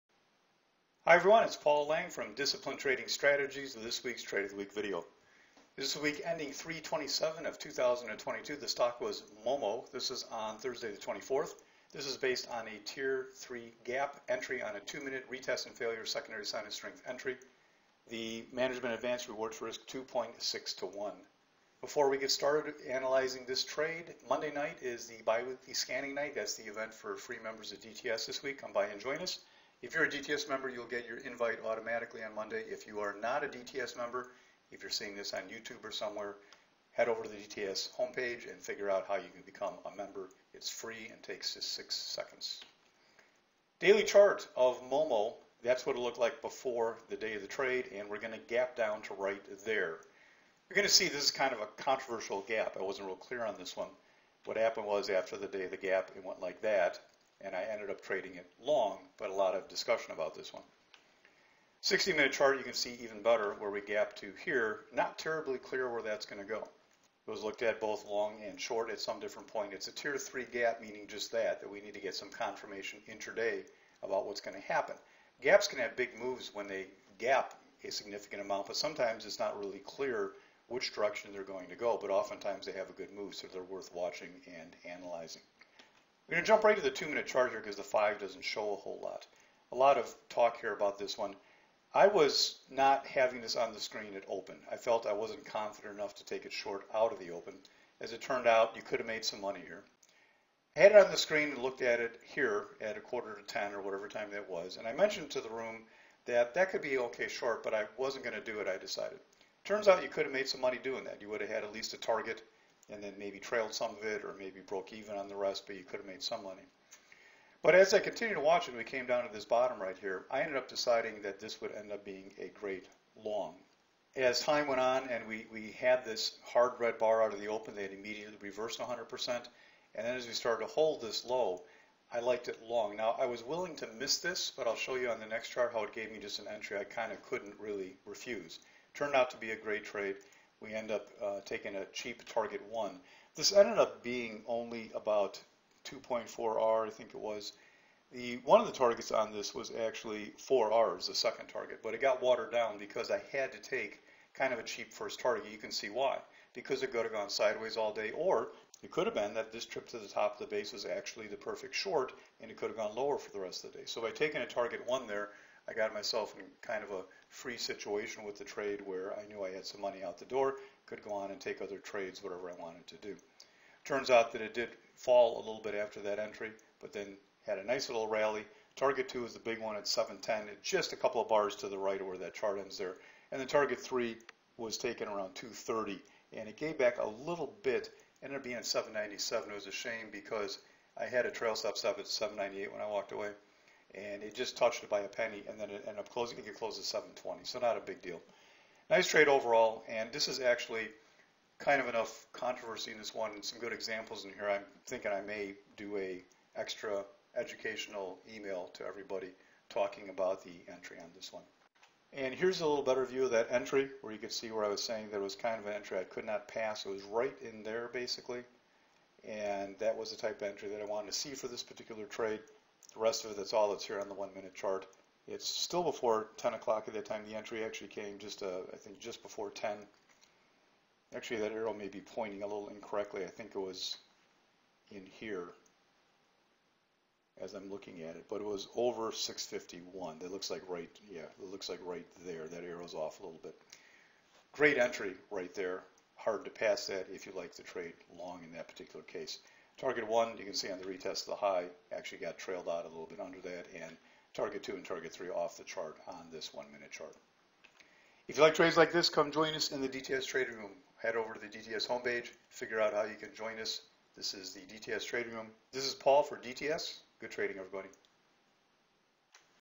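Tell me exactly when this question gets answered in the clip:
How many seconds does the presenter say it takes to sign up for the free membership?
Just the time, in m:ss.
0:41.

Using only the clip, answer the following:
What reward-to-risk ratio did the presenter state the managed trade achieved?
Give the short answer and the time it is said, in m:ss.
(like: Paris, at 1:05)
2.6 to 1, at 0:19.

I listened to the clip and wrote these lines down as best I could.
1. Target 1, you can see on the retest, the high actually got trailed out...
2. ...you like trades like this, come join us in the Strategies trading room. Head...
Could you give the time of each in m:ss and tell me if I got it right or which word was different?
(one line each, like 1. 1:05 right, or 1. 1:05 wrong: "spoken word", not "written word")
1. 4:09 right
2. 4:18 wrong: "DTS", not "Strategies".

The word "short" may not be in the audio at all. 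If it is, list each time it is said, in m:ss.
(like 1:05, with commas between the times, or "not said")
1:08, 1:36, 1:47, 2:41.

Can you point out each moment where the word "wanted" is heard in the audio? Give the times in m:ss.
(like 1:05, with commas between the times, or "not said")
2:52, 3:40.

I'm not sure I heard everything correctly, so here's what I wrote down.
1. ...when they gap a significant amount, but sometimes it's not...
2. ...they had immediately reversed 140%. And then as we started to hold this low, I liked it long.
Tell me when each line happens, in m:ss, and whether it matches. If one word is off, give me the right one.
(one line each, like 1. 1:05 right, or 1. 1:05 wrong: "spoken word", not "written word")
1. 1:16 right
2. 2:07 wrong: "100", not "140".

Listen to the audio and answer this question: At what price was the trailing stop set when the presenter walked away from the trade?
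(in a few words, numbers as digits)
7.98.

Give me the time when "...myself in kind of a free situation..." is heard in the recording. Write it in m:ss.
2:45.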